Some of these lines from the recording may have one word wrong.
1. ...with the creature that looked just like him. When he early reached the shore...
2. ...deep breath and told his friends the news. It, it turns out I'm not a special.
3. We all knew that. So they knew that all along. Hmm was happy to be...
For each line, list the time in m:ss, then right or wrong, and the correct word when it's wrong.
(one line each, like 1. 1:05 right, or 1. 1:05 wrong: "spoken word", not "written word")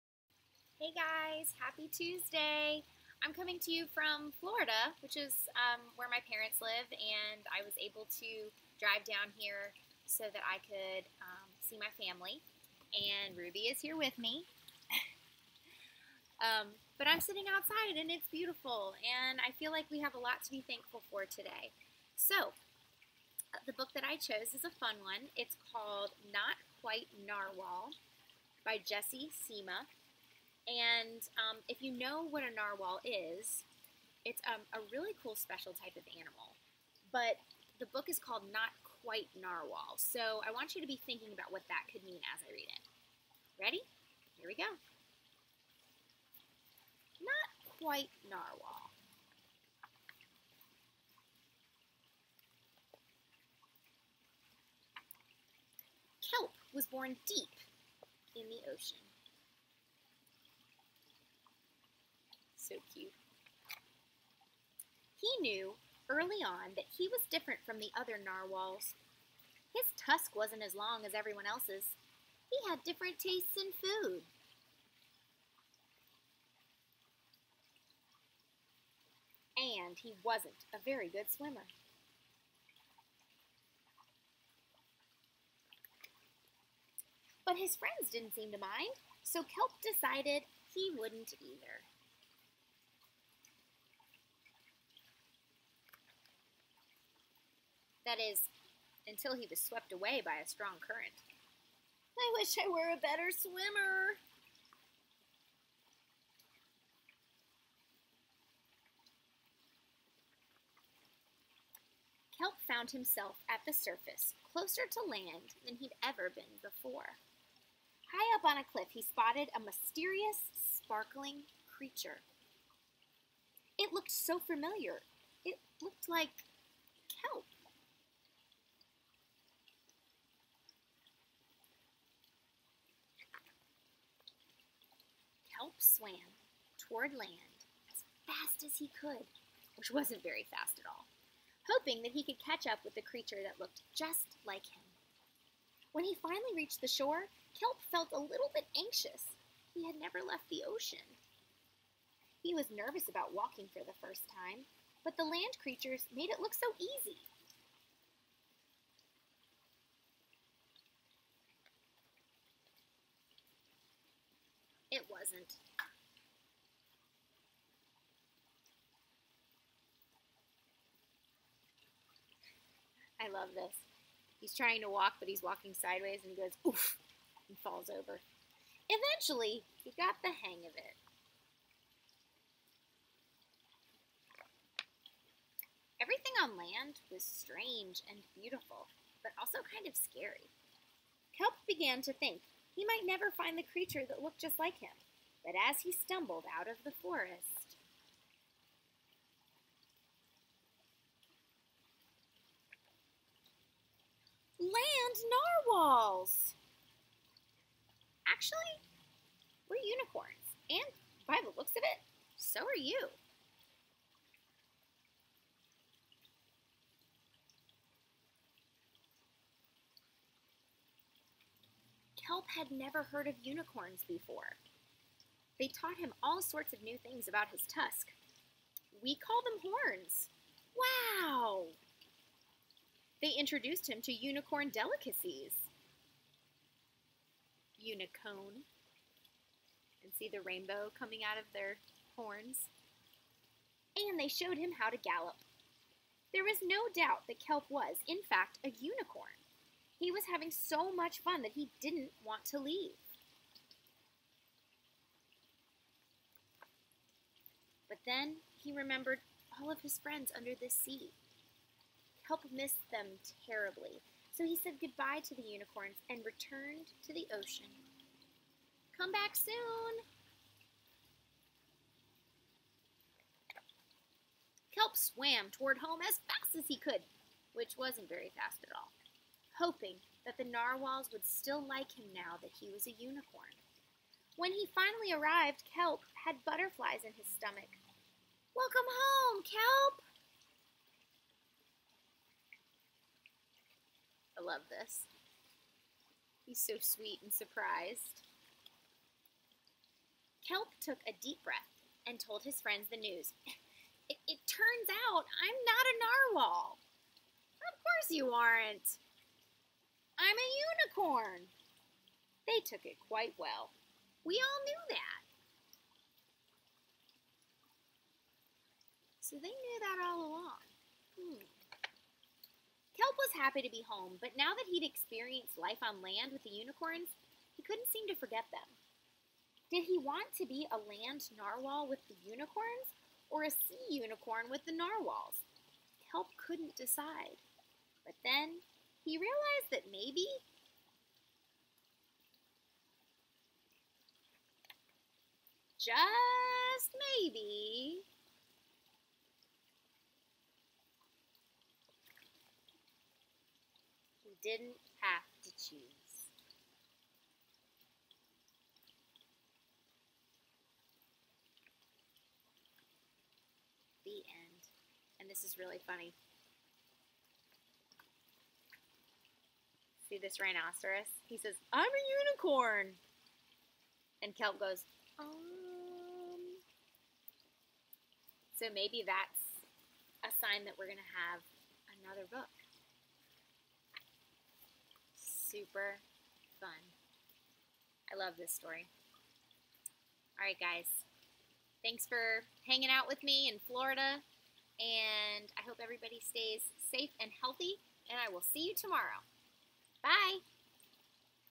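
1. 2:22 wrong: "finally", not "early"
2. 5:01 wrong: "narwhal", not "special"
3. 5:14 right.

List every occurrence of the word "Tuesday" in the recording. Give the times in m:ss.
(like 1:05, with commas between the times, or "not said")
0:01.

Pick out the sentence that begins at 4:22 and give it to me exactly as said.
Kelp missed them terribly, so he said goodbye to the unicorns and returned to the ocean.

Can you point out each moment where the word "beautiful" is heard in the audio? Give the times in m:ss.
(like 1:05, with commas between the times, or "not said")
0:18, 3:08.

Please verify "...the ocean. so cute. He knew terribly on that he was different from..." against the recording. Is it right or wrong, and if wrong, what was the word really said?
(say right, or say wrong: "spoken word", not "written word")
wrong: "early", not "terribly".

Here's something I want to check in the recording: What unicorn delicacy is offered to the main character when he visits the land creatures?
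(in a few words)
Unicone.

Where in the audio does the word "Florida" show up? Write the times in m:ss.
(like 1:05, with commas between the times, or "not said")
0:04, 6:33.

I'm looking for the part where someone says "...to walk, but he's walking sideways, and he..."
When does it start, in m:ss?
2:54.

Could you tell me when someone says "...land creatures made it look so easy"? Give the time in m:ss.
2:35.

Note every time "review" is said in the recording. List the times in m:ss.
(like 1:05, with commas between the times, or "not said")
not said.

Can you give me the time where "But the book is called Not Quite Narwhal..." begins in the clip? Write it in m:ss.
0:37.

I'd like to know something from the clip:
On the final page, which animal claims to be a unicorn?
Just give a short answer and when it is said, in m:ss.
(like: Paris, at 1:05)
Rhinoceros, at 6:10.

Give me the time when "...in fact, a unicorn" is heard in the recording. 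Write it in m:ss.
4:08.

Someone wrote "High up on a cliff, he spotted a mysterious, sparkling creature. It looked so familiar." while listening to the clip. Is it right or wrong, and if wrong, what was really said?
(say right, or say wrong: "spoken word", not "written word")
right.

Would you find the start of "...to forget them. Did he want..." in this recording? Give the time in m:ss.
5:28.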